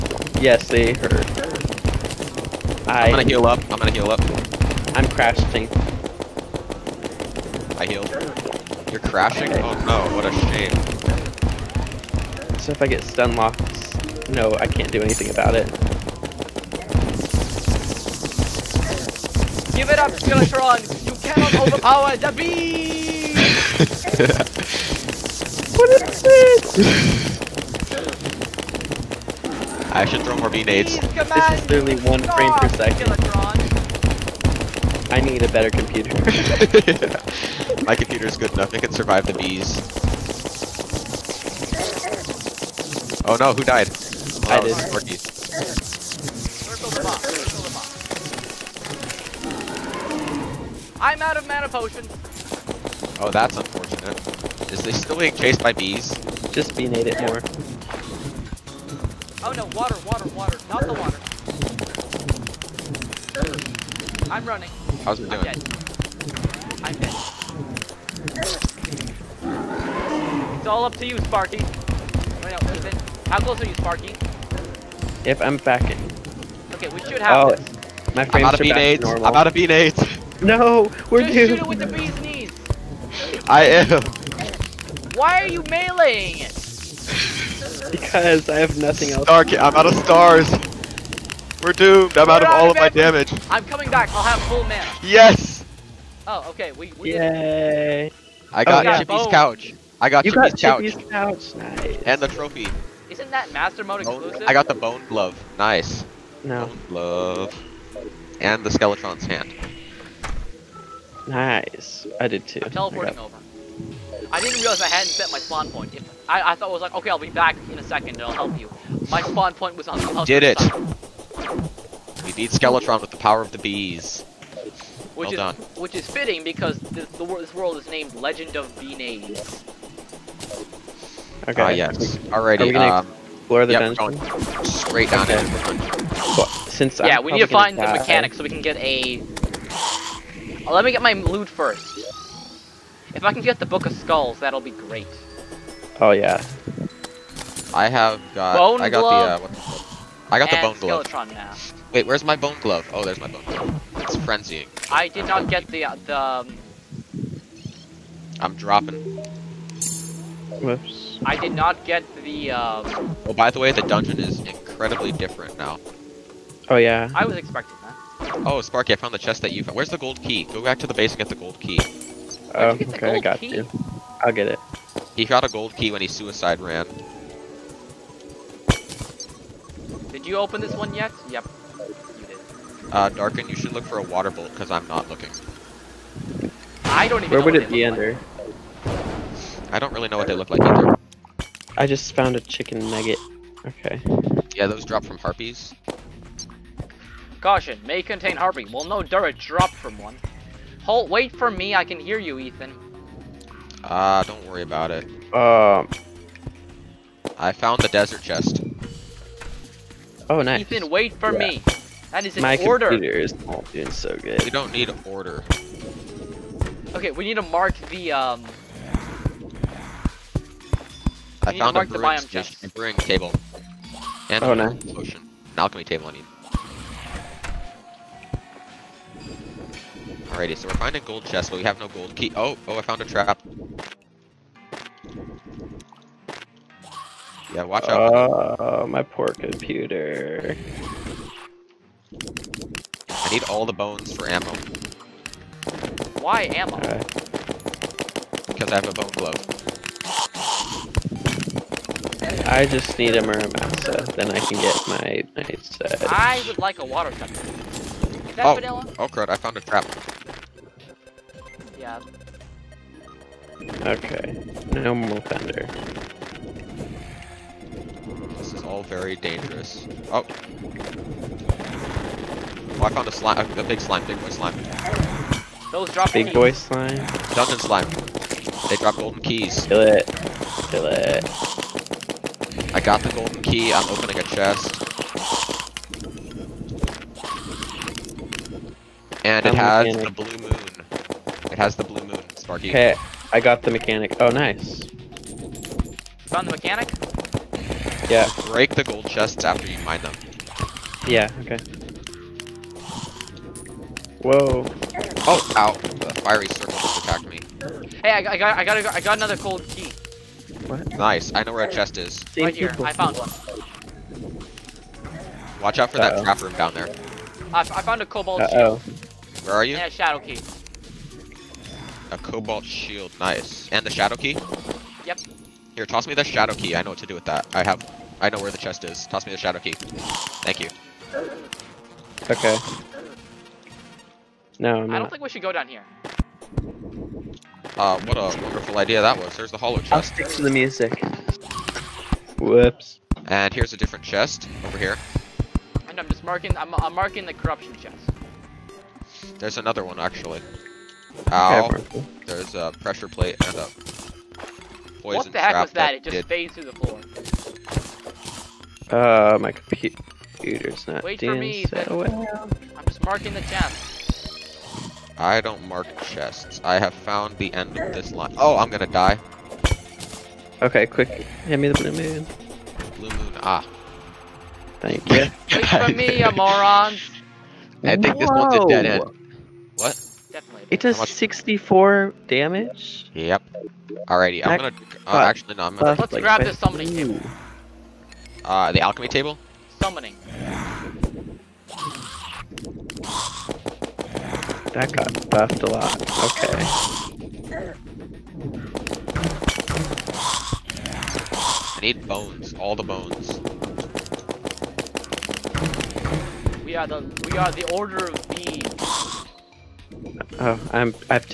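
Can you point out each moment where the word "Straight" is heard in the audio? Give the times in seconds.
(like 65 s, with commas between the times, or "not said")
134 s.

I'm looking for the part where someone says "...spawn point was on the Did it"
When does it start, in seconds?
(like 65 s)
119 s.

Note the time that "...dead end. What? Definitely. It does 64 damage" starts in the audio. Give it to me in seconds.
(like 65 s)
378 s.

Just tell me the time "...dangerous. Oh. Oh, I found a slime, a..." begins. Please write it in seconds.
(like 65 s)
269 s.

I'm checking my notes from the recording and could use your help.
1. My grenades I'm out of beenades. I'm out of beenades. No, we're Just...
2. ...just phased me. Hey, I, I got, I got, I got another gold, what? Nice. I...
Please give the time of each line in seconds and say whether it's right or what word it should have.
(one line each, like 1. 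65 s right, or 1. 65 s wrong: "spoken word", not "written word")
1. 78 s wrong: "frames", not "grenades"
2. 306 s wrong: "attacked", not "phased".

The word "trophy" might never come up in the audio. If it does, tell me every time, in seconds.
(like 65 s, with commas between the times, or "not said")
102 s.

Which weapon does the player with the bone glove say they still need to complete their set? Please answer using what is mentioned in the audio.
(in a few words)
Muramasa.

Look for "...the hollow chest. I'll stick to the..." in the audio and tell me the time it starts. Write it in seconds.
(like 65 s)
339 s.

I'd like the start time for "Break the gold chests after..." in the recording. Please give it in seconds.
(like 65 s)
298 s.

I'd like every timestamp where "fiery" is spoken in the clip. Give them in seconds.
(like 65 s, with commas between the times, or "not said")
306 s.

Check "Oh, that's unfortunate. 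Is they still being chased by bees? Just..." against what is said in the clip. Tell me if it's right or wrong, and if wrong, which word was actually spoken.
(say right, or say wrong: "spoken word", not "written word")
right.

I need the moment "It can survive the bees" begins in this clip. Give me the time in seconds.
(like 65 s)
38 s.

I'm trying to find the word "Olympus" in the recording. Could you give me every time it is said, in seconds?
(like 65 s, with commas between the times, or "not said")
not said.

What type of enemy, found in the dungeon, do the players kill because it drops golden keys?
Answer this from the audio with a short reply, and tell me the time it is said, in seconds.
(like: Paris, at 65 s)
Dungeon slime, at 277 s.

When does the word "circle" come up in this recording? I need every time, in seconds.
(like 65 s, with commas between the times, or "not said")
44 s, 306 s.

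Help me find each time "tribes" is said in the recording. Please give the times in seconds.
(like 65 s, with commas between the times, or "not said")
not said.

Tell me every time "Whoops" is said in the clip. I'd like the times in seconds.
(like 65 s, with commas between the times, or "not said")
160 s, 342 s.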